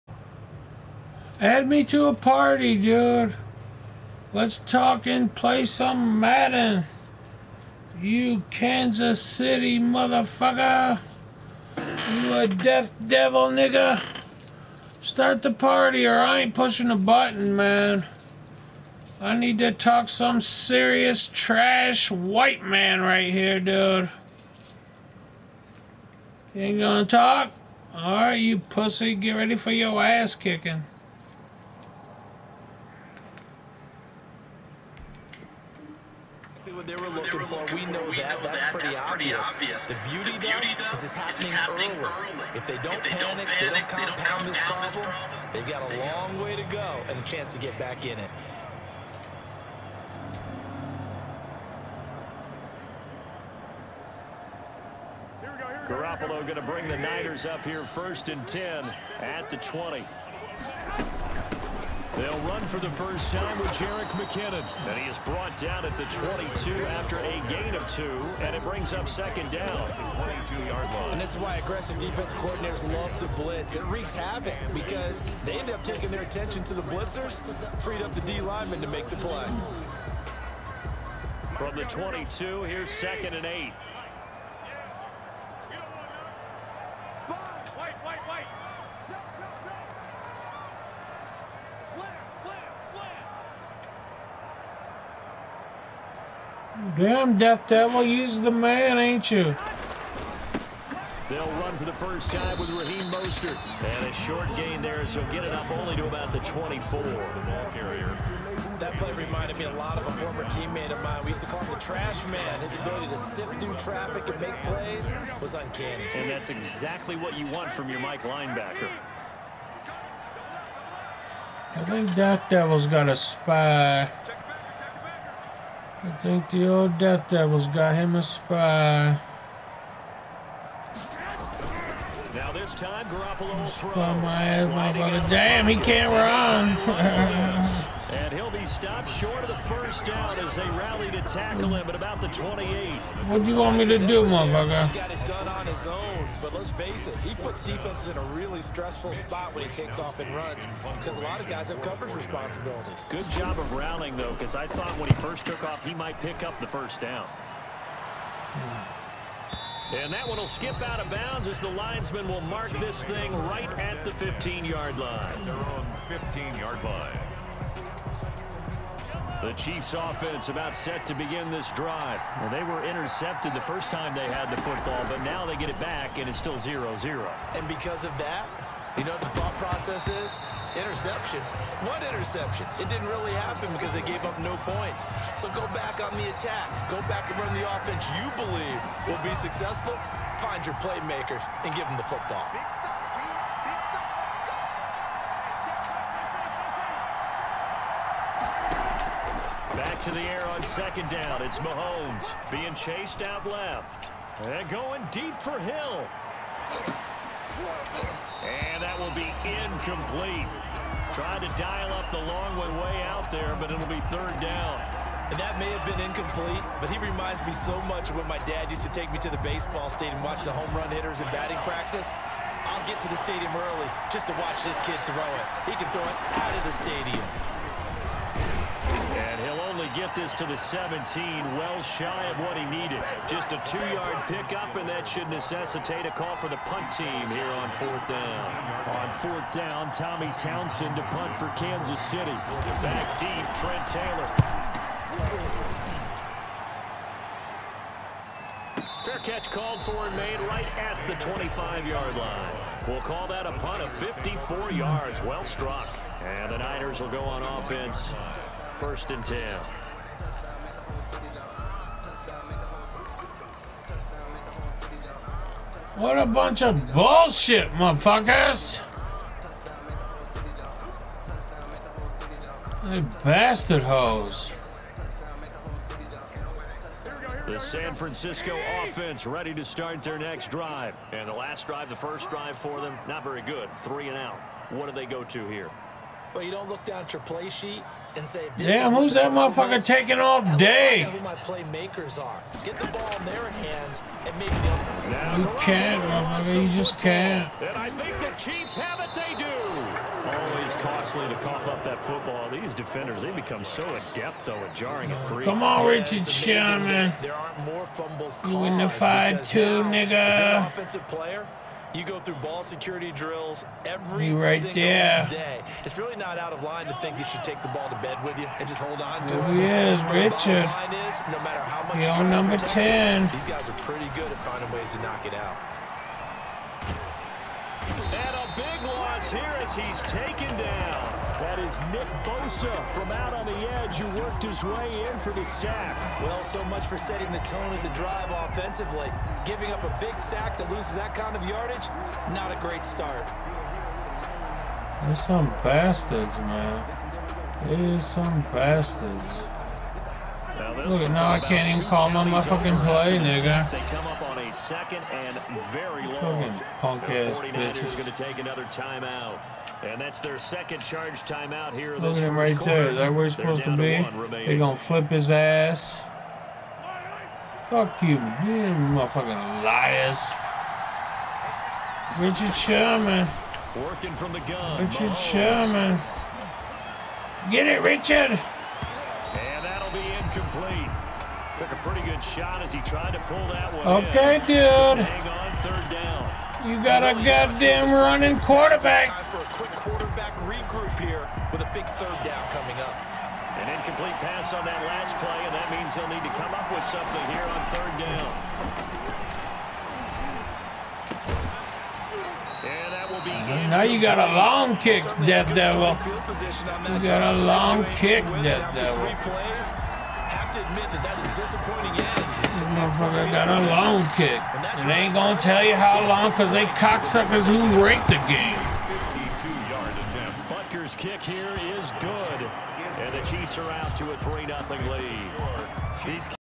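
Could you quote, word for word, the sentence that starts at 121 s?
I think that Devil's got a spy.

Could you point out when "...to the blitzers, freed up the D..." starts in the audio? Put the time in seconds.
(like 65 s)
76 s.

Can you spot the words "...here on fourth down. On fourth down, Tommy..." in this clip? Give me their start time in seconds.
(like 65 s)
237 s.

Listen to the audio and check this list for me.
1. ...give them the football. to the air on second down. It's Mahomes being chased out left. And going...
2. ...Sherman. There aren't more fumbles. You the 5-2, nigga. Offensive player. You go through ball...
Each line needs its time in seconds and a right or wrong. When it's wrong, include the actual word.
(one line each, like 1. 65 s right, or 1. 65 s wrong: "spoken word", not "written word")
1. 191 s right
2. 306 s right.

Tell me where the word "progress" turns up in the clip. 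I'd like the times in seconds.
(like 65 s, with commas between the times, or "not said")
not said.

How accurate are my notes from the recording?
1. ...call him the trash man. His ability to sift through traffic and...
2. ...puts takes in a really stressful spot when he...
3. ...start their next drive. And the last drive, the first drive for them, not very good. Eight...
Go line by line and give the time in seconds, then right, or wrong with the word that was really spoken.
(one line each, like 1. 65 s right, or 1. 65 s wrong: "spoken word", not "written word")
1. 111 s right
2. 147 s wrong: "defenses", not "takes"
3. 279 s wrong: "Three", not "Eight".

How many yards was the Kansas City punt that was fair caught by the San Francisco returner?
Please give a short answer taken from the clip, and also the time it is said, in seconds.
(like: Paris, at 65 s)
54 yards, at 253 s.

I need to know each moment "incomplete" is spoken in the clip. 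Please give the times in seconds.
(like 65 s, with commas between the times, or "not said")
209 s, 216 s, 379 s, 393 s.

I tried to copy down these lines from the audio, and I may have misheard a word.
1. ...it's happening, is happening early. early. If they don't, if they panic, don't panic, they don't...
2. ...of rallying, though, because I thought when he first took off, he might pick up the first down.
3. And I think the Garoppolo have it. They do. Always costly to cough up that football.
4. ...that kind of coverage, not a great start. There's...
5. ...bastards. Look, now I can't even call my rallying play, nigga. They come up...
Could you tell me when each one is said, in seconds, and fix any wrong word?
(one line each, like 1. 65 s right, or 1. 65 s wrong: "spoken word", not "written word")
1. 41 s right
2. 153 s right
3. 297 s wrong: "Chiefs", not "Garoppolo"
4. 340 s wrong: "yardage", not "coverage"
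5. 348 s wrong: "motherfucking", not "rallying".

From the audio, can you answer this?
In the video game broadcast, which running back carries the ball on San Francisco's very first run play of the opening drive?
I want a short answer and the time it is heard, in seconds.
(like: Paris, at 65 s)
Jerick McKinnon, at 63 s.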